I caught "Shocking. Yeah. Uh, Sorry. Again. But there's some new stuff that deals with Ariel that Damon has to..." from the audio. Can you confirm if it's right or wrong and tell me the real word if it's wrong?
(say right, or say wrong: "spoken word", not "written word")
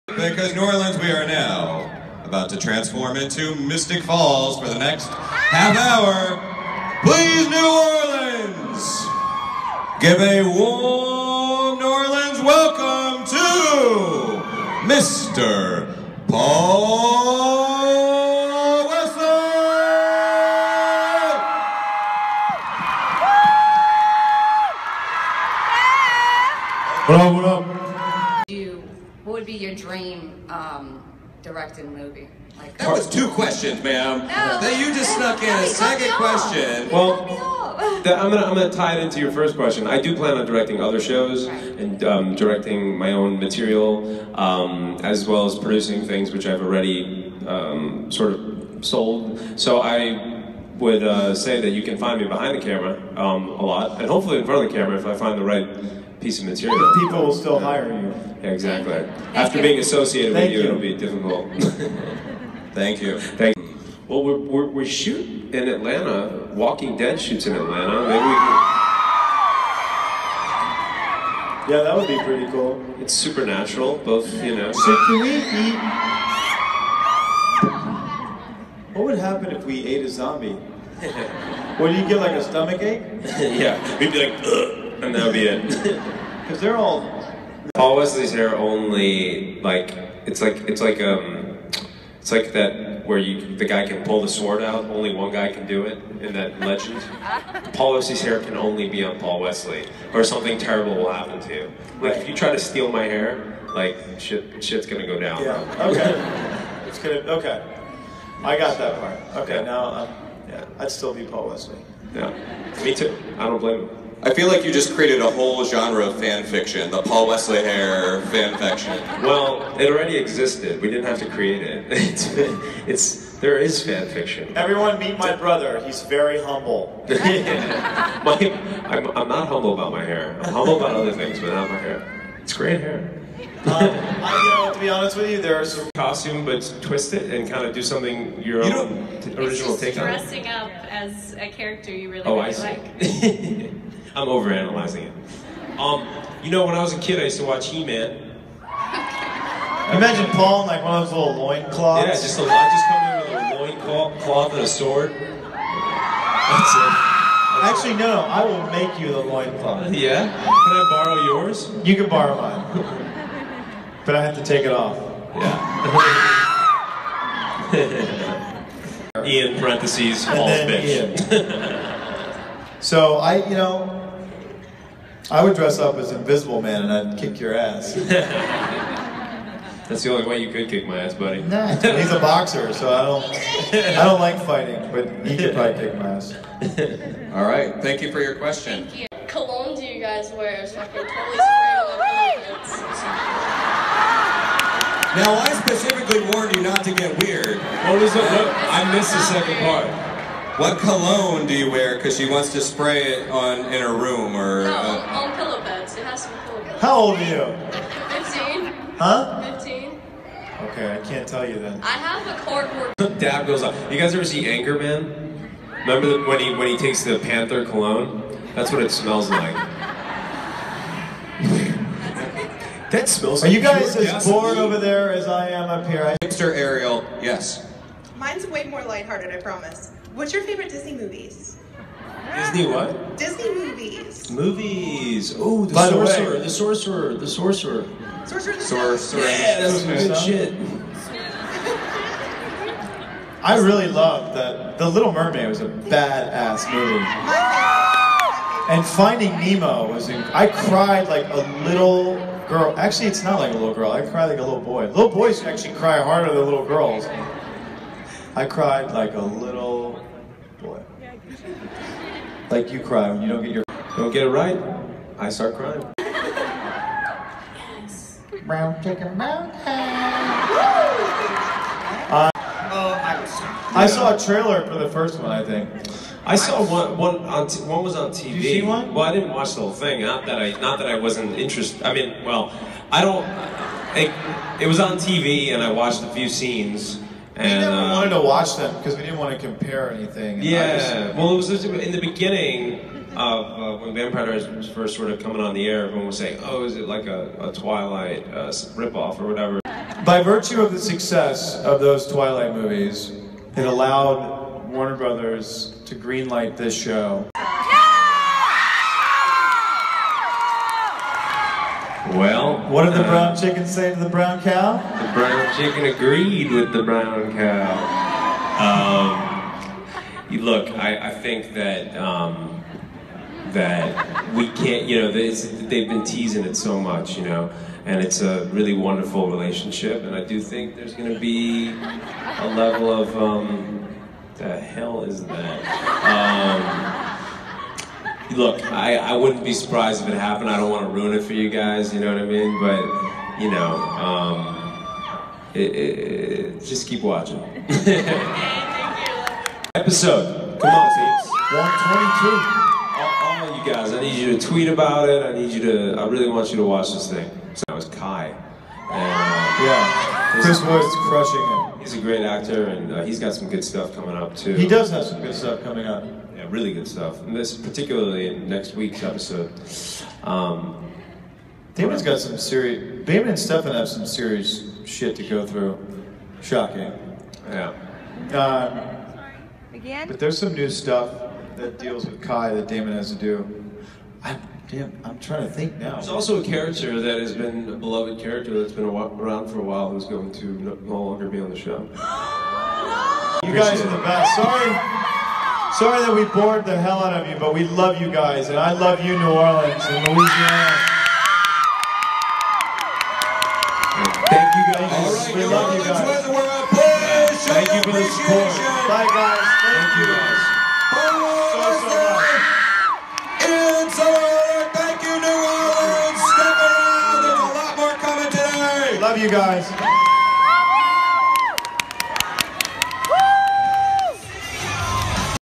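wrong: "Kai", not "Ariel".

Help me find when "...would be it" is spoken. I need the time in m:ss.
1:25.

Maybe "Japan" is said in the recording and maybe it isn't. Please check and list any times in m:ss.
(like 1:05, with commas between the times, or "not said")
not said.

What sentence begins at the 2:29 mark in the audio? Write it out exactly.
Imagine Paul in like one of those little cloths.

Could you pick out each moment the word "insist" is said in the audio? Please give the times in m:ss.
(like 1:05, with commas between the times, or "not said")
not said.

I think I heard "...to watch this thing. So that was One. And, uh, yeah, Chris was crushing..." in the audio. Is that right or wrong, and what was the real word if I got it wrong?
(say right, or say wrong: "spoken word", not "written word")
wrong: "Kai", not "One".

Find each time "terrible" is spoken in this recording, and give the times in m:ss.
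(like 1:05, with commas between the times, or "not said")
1:40.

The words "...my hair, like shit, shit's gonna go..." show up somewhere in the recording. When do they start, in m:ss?
1:42.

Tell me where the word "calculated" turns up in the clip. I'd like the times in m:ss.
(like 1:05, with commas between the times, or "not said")
not said.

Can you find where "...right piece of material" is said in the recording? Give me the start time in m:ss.
0:55.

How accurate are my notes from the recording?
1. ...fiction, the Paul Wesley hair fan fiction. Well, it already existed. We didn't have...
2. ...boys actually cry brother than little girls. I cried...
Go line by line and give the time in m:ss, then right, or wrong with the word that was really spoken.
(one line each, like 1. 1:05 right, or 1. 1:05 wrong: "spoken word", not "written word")
1. 1:56 right
2. 4:15 wrong: "harder", not "brother".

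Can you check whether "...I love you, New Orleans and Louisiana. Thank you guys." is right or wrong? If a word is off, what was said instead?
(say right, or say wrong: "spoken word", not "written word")
right.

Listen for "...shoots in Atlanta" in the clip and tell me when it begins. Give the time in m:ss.
1:07.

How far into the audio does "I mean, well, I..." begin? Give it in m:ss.
4:41.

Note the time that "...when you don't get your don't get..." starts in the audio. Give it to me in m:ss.
4:23.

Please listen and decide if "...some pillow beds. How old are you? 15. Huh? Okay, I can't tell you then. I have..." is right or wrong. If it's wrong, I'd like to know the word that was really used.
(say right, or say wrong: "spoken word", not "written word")
right.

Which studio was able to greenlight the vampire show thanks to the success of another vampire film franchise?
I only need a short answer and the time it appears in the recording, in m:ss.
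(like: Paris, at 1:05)
Warner Brothers, at 5:04.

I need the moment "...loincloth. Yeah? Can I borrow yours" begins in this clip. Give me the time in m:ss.
2:39.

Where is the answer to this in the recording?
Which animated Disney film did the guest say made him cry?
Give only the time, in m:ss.
4:08.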